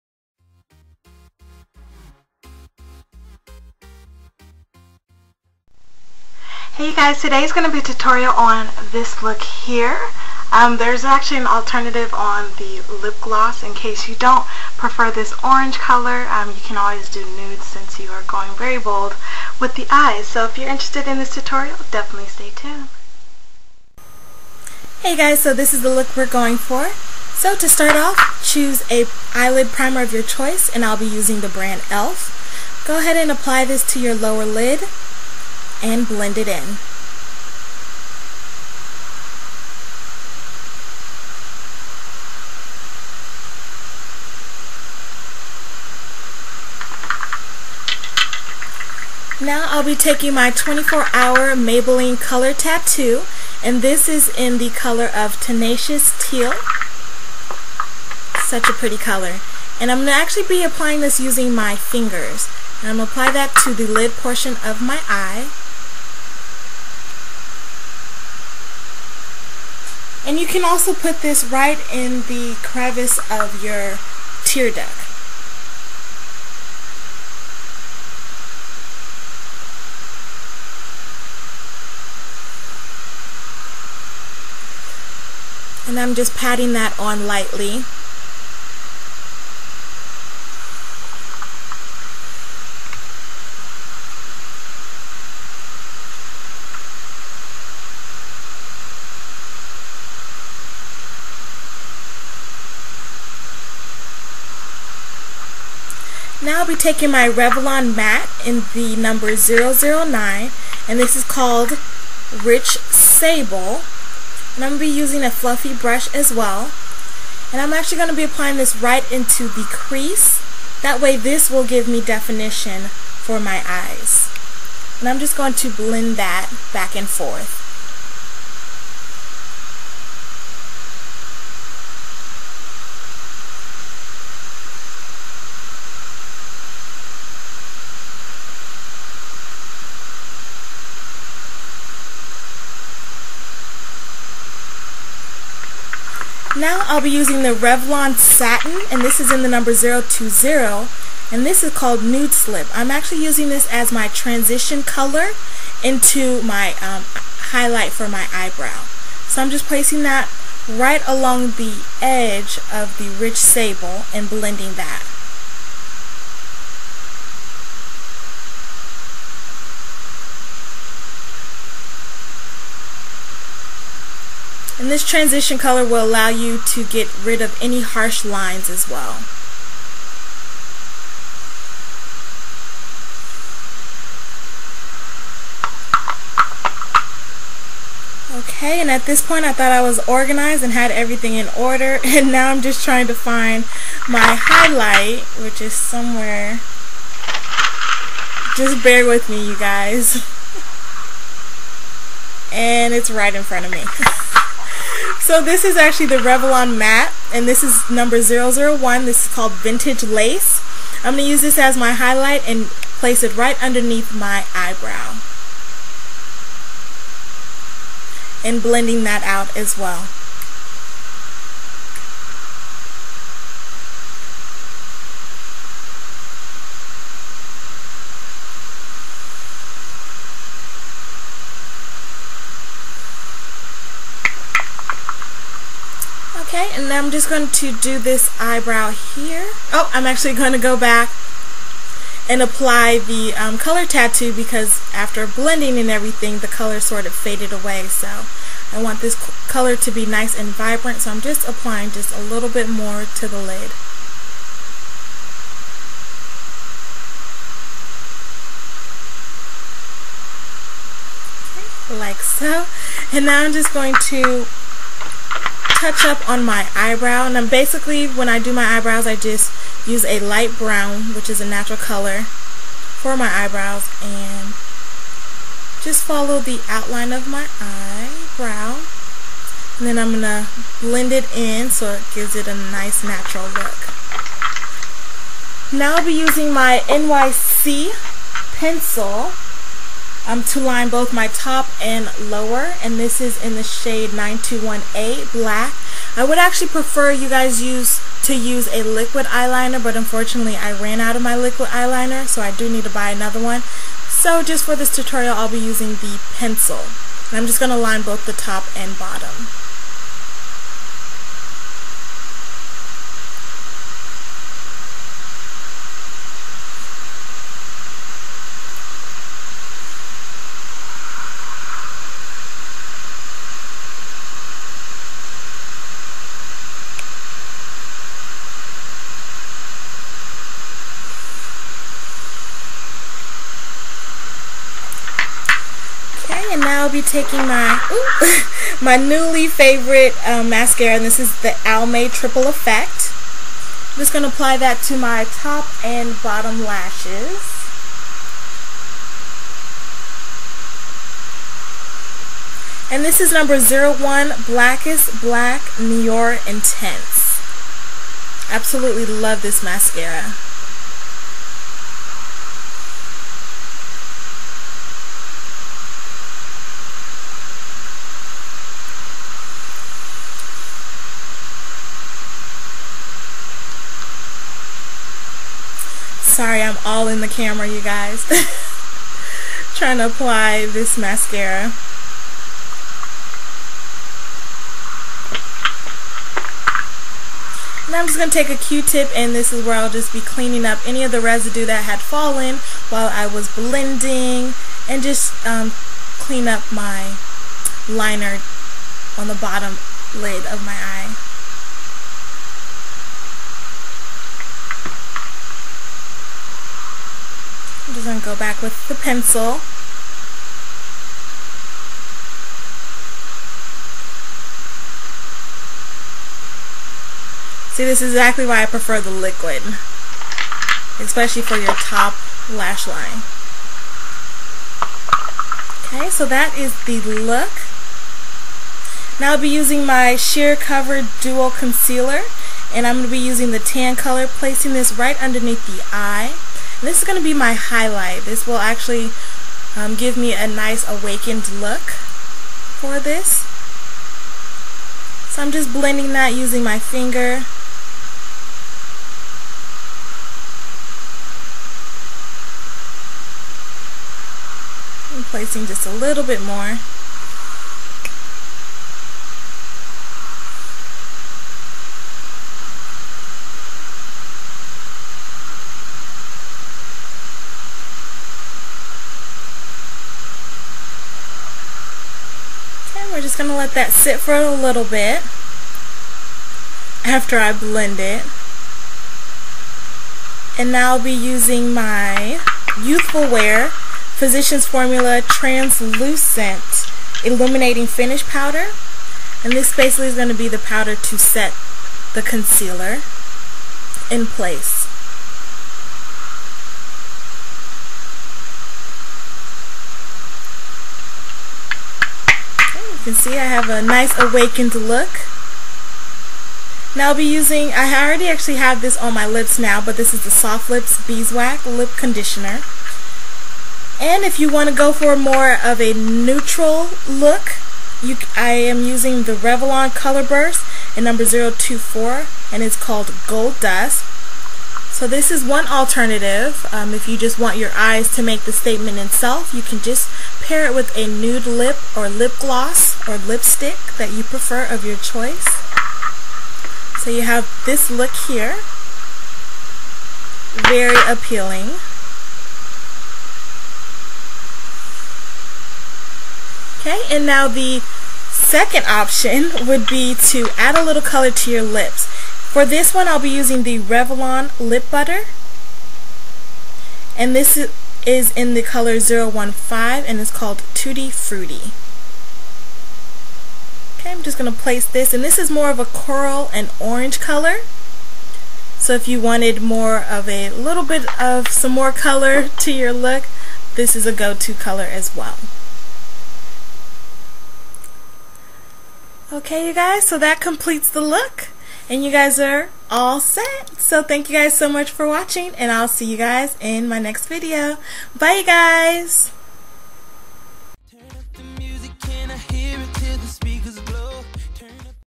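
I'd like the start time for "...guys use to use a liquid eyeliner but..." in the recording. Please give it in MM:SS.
04:57.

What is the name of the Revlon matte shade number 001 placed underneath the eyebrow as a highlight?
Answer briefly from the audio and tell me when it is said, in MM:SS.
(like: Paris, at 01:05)
Vintage Lace, at 03:29.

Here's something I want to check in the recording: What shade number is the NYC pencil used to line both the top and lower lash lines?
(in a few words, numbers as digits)
921A.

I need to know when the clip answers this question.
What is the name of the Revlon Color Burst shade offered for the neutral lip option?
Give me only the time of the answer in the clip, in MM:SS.
08:43.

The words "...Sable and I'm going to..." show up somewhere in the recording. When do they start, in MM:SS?
01:52.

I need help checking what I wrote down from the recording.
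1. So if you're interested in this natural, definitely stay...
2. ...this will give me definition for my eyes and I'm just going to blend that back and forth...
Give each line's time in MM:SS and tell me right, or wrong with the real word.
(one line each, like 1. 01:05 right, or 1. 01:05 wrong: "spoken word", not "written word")
1. 00:20 wrong: "tutorial", not "natural"
2. 02:01 right.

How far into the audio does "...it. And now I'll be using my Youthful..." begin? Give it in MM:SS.
07:57.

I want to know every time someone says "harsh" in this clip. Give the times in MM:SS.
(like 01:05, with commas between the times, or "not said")
02:57.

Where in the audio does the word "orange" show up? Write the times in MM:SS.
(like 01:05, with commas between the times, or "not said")
00:15, 09:26.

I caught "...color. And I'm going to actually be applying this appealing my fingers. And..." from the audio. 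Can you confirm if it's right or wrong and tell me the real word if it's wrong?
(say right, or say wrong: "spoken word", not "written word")
wrong: "using", not "appealing".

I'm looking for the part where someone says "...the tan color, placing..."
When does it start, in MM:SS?
07:13.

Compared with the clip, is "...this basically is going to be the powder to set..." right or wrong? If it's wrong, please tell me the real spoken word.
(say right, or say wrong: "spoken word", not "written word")
right.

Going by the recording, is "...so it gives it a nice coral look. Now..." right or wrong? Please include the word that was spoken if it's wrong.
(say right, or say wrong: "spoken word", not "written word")
wrong: "natural", not "coral".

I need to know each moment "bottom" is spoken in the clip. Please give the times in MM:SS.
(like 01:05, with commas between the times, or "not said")
05:08, 05:46, 06:39.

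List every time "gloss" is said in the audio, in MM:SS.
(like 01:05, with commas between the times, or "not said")
00:13, 08:52.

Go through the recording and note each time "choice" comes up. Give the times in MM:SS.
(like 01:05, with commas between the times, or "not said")
00:30, 08:54.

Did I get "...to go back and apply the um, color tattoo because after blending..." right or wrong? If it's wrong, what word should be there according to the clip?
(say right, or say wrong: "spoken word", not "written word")
right.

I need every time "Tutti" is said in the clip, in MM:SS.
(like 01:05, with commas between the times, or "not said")
09:20.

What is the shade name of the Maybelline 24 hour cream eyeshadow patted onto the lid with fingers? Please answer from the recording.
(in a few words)
Tenacious Teal.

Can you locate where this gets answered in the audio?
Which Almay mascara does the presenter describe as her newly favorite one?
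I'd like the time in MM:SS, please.
05:41.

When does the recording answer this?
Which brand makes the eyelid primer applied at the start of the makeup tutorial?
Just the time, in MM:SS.
00:31.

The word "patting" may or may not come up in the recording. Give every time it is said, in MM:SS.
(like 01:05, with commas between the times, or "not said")
01:26.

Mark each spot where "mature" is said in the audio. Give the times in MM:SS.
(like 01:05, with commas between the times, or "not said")
not said.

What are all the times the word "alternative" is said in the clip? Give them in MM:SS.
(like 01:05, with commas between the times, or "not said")
00:11, 08:45.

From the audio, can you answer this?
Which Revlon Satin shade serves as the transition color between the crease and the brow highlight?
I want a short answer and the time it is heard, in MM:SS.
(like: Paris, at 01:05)
Nude Slip, at 02:32.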